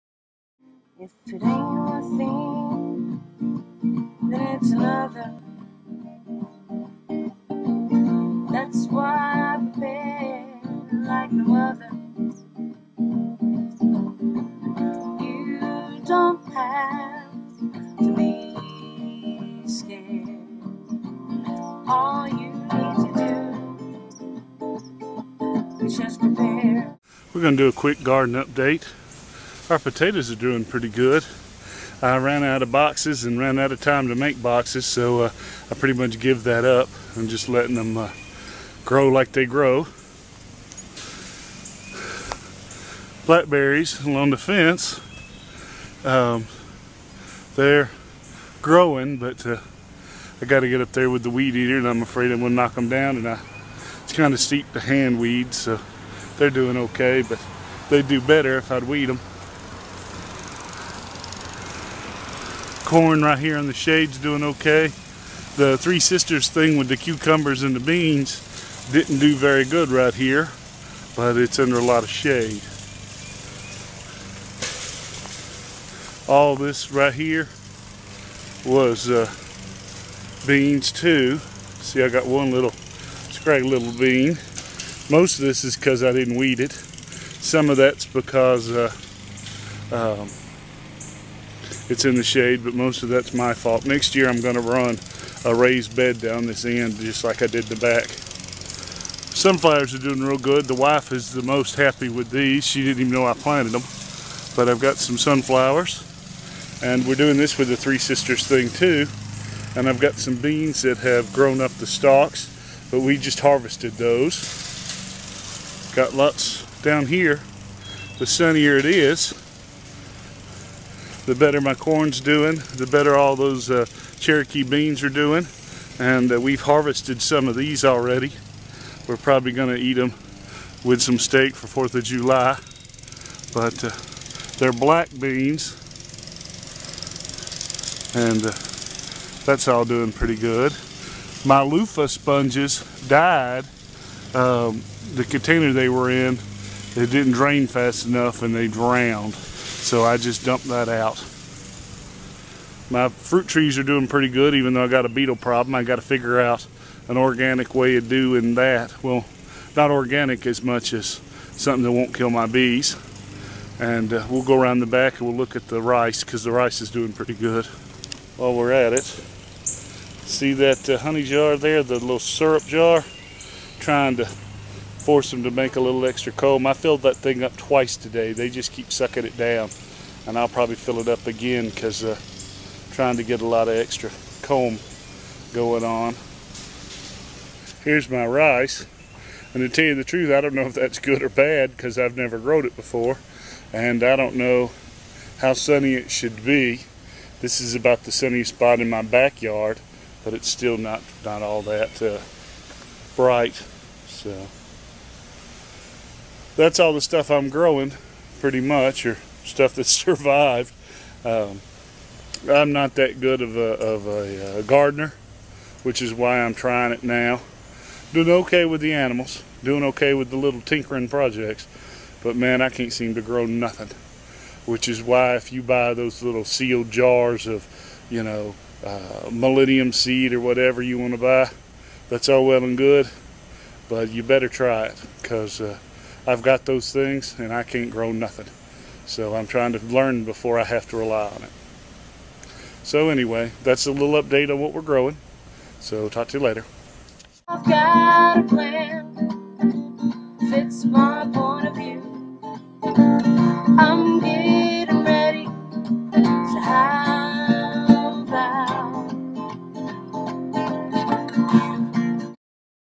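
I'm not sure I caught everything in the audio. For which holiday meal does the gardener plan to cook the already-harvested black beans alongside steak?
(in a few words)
4th of July.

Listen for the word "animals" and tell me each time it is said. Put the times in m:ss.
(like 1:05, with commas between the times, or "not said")
3:38.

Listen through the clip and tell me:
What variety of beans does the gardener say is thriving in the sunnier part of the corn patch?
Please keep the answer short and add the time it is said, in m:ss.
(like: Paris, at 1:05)
Cherokee beans, at 2:04.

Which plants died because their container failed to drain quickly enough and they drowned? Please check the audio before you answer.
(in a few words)
loofah sponges.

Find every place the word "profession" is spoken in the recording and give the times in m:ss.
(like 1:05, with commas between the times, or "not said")
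not said.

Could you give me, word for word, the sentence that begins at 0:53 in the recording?
And I, it's kind of steep to hand weed, so they're doing okay, but they'd do better if I'd weed them.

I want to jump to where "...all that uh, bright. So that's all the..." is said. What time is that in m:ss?
3:21.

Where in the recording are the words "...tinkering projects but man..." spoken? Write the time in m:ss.
3:40.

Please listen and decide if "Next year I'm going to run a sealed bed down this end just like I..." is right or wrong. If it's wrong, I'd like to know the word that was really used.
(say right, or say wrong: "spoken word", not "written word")
wrong: "raised", not "sealed".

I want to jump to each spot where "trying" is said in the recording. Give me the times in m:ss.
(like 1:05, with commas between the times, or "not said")
2:53, 3:02, 3:36, 3:59.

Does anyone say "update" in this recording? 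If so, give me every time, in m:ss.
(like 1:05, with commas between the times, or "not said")
0:28, 4:04.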